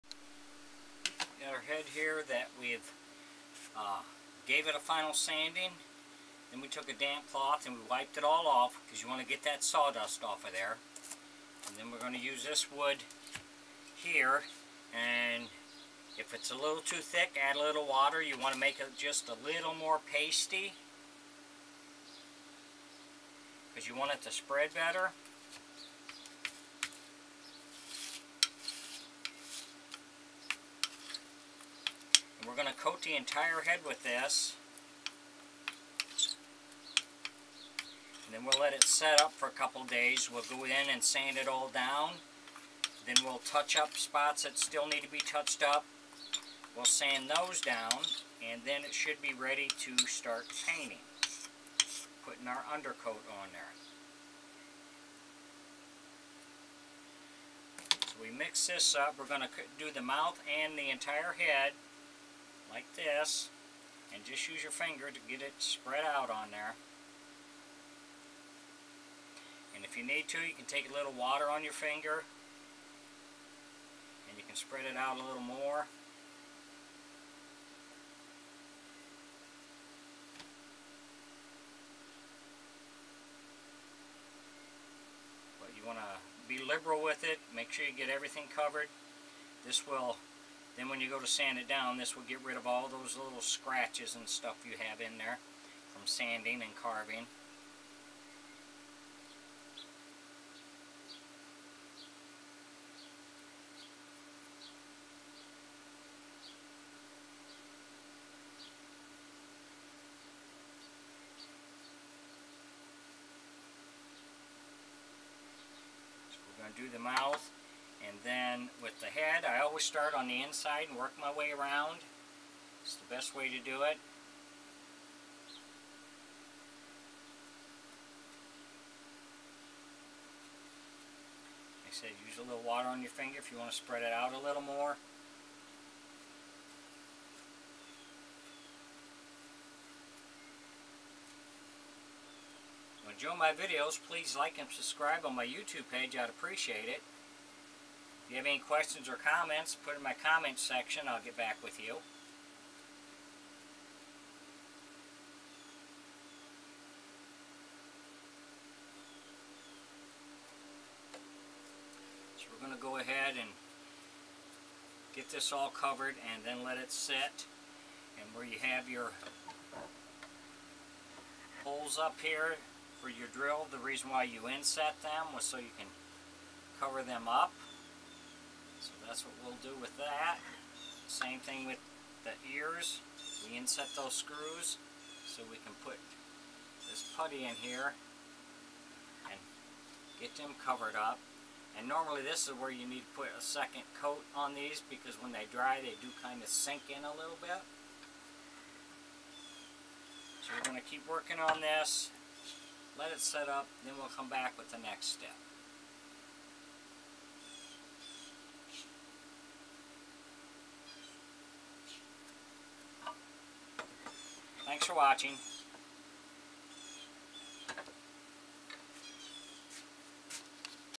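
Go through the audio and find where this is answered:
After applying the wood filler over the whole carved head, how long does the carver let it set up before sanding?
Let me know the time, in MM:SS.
00:39.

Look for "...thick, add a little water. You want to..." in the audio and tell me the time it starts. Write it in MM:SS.
00:16.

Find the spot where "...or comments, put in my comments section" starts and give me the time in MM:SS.
02:29.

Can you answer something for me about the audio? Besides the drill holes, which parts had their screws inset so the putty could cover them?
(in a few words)
The ears.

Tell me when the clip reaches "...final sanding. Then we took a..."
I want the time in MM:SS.
00:04.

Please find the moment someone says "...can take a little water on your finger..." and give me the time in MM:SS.
01:10.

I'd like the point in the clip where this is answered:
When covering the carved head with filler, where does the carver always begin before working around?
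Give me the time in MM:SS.
02:00.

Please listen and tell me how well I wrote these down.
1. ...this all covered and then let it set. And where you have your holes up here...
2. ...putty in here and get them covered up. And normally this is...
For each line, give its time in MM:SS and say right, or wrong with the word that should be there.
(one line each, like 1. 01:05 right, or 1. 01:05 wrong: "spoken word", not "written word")
1. 02:45 right
2. 03:07 right.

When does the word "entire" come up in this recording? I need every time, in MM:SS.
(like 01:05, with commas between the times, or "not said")
00:33, 01:00.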